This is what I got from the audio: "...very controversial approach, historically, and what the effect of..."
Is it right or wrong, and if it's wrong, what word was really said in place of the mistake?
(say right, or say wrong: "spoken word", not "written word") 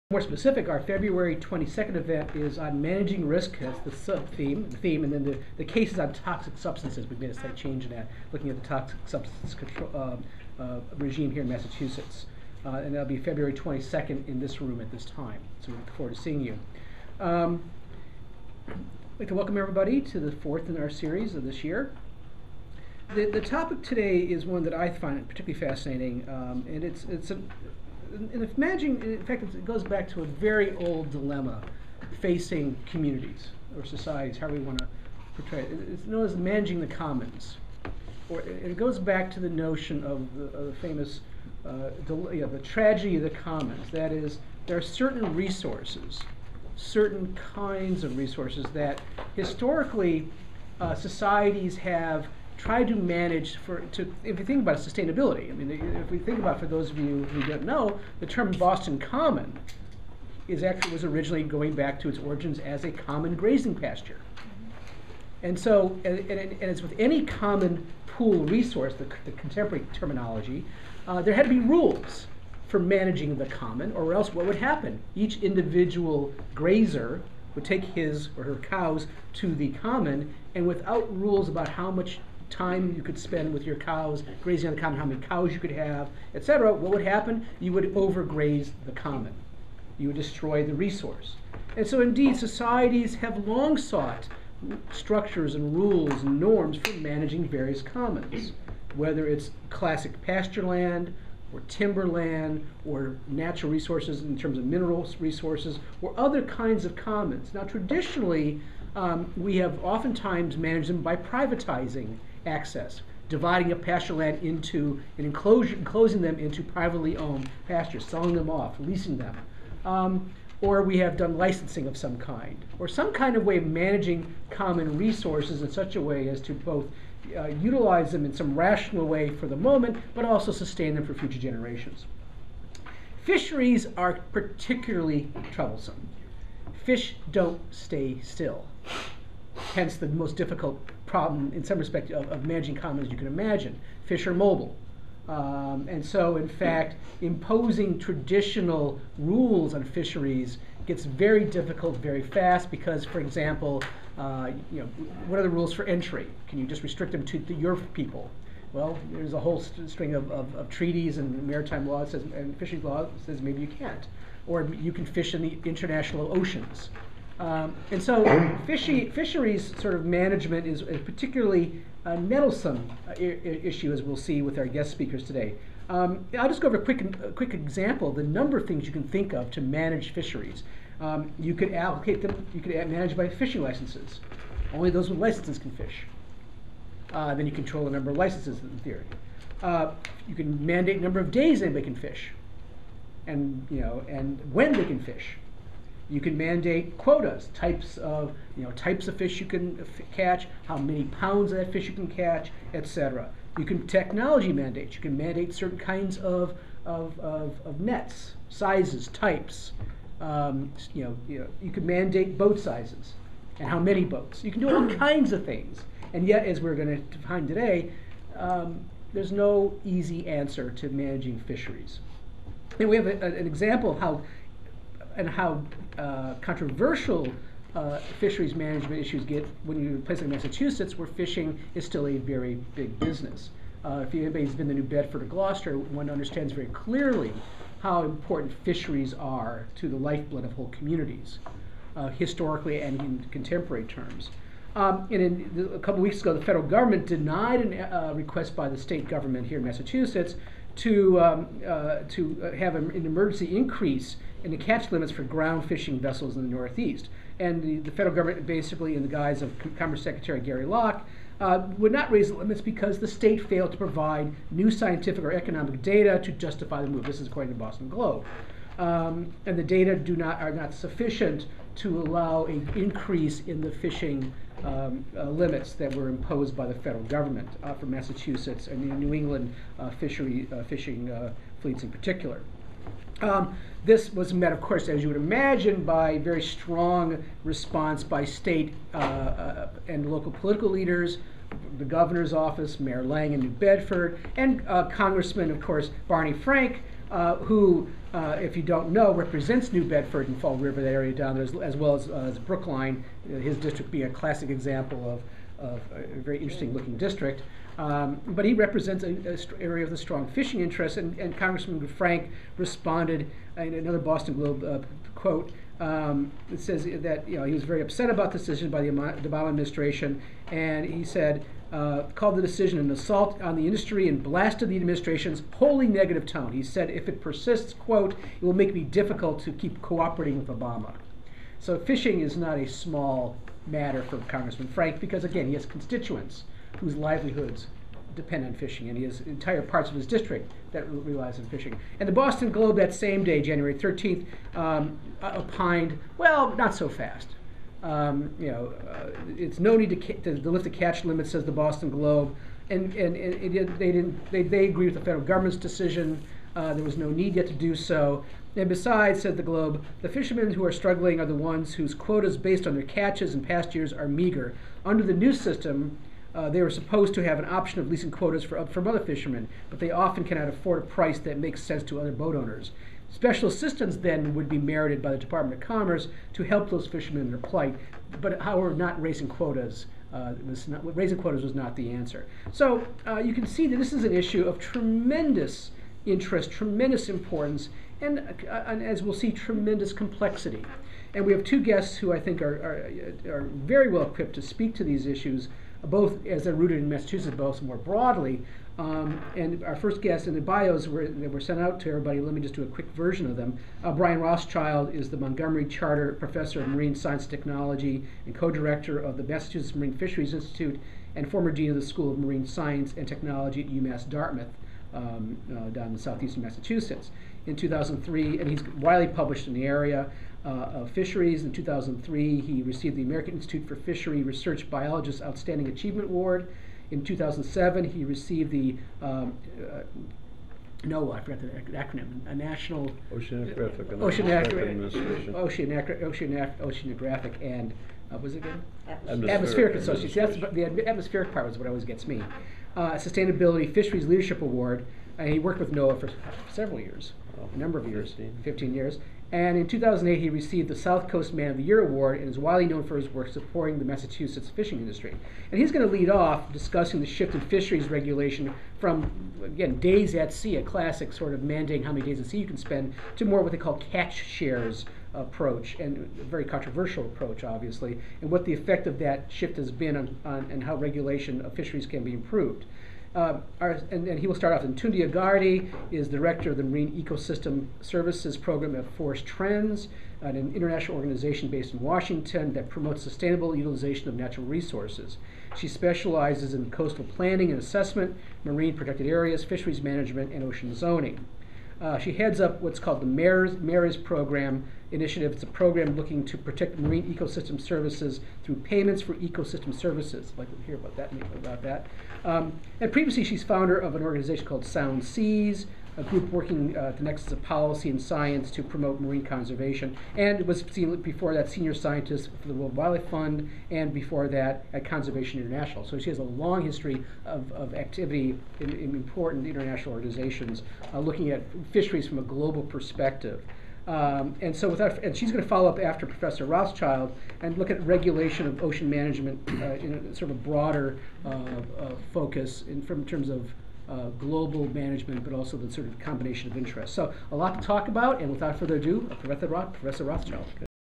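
wrong: "obviously", not "historically".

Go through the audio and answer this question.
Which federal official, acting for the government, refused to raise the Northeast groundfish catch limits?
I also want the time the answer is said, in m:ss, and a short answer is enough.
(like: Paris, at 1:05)
Gary Locke, at 4:20.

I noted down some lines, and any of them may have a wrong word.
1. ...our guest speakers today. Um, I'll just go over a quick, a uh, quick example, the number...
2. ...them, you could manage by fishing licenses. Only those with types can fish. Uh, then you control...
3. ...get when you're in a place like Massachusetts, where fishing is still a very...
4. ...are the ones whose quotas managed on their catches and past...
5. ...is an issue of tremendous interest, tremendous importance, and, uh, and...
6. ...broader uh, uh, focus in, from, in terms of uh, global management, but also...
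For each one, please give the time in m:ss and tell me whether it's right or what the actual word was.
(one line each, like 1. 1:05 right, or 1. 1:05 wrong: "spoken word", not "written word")
1. 2:54 right
2. 3:02 wrong: "licenses", not "types"
3. 3:49 right
4. 6:01 wrong: "based", not "managed"
5. 6:23 right
6. 8:50 right.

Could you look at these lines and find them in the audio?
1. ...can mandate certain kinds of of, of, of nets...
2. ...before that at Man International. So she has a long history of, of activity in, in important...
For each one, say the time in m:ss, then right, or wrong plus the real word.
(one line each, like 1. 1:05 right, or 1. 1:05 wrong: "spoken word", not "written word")
1. 3:25 right
2. 8:33 wrong: "Conservation", not "Man".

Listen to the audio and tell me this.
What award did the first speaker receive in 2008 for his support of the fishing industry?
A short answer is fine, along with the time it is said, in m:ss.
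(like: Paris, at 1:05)
South Coast Man of the Year, at 7:30.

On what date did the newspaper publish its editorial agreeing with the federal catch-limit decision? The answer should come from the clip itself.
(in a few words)
January 13th.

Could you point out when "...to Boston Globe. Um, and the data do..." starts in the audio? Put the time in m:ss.
4:27.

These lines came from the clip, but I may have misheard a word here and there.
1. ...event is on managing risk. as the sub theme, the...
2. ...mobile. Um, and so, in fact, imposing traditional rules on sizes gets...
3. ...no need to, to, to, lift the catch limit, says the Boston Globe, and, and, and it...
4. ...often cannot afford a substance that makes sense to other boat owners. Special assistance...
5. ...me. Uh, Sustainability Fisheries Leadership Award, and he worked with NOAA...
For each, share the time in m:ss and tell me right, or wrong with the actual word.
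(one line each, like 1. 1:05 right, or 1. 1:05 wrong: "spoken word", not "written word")
1. 0:01 right
2. 2:24 wrong: "fisheries", not "sizes"
3. 5:49 right
4. 6:09 wrong: "price", not "substance"
5. 7:22 right.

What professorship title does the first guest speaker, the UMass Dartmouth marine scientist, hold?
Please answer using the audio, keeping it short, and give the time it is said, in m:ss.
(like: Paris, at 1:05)
Montgomery Charter Professor, at 6:45.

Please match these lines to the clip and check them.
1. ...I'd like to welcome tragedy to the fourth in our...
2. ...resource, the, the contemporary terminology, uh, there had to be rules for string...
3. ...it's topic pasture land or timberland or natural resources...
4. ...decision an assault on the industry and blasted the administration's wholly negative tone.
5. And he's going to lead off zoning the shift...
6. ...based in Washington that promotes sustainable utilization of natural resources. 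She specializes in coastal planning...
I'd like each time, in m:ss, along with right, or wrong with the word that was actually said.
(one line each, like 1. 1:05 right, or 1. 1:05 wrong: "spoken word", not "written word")
1. 0:18 wrong: "everybody", not "tragedy"
2. 1:08 wrong: "managing", not "string"
3. 1:39 wrong: "classic", not "topic"
4. 5:22 right
5. 7:35 wrong: "discussing", not "zoning"
6. 8:01 right.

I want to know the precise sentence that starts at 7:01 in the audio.
In 2003, he received the American Institute for Fishery Research Biologist Outstanding Achievement Award.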